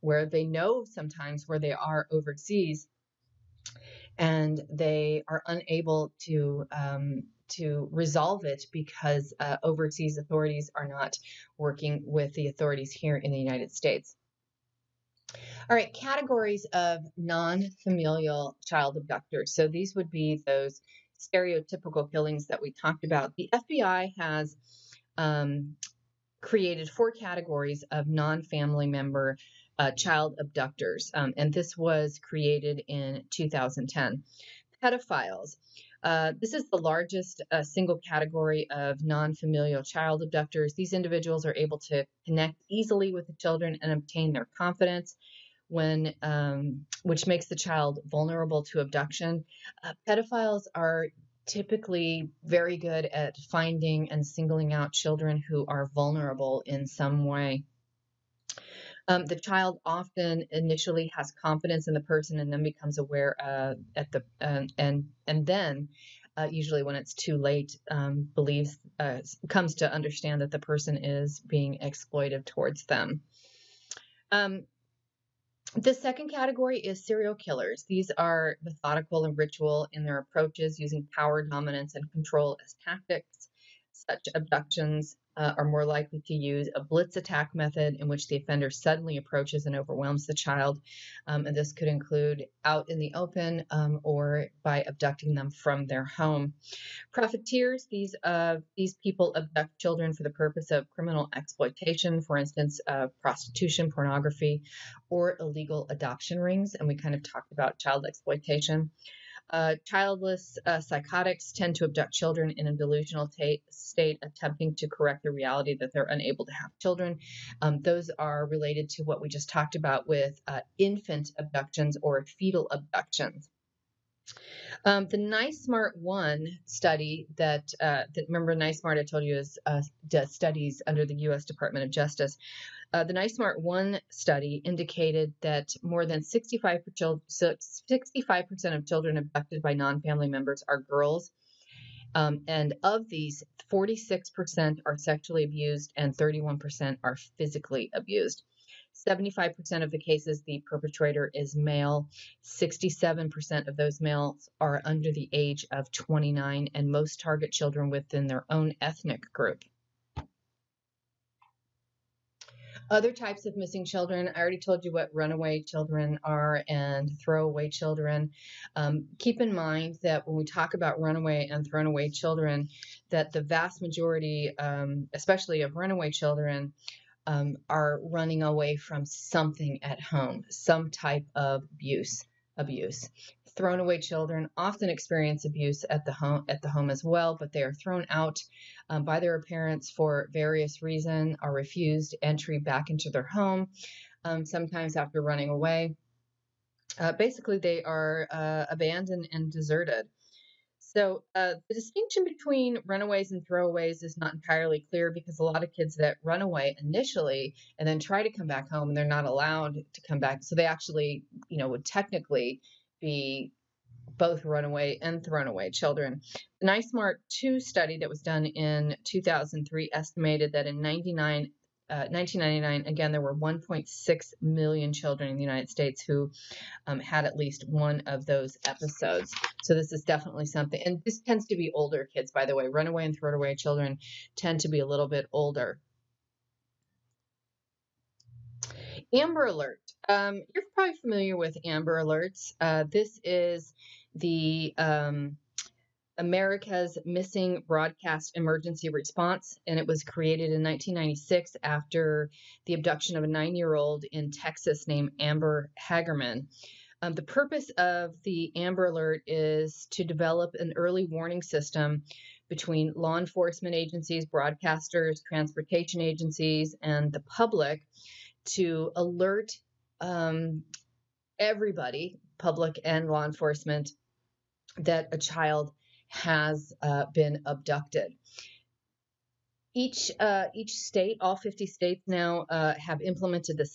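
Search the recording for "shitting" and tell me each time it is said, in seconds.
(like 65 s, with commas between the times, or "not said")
not said.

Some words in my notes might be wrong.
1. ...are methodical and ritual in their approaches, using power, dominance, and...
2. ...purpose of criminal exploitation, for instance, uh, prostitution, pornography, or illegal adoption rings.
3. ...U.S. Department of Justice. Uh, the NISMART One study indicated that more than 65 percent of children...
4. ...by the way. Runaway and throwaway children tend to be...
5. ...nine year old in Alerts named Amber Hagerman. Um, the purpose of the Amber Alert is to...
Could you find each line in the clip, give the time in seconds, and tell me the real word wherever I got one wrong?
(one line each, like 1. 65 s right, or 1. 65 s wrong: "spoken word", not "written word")
1. 78 s right
2. 100 s right
3. 131 s right
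4. 232 s right
5. 253 s wrong: "Texas", not "Alerts".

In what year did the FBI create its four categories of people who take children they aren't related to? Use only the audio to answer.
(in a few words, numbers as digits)
2010.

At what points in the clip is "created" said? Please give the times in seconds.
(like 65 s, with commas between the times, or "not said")
26 s, 32 s, 250 s.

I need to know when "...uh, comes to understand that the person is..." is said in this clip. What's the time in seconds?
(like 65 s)
68 s.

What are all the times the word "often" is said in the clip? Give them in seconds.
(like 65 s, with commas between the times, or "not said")
59 s, 184 s.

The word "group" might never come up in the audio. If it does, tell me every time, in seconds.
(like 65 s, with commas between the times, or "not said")
159 s.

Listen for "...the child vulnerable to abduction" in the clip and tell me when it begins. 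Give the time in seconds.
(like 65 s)
47 s.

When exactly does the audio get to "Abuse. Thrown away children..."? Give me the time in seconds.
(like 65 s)
182 s.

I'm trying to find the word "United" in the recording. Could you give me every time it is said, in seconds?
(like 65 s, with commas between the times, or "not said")
13 s, 225 s.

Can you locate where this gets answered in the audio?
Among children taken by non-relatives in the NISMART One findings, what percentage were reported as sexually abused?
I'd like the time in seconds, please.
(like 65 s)
143 s.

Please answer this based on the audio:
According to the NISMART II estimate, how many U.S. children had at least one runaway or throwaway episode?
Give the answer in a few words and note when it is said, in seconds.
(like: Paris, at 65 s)
1.6 million, at 223 s.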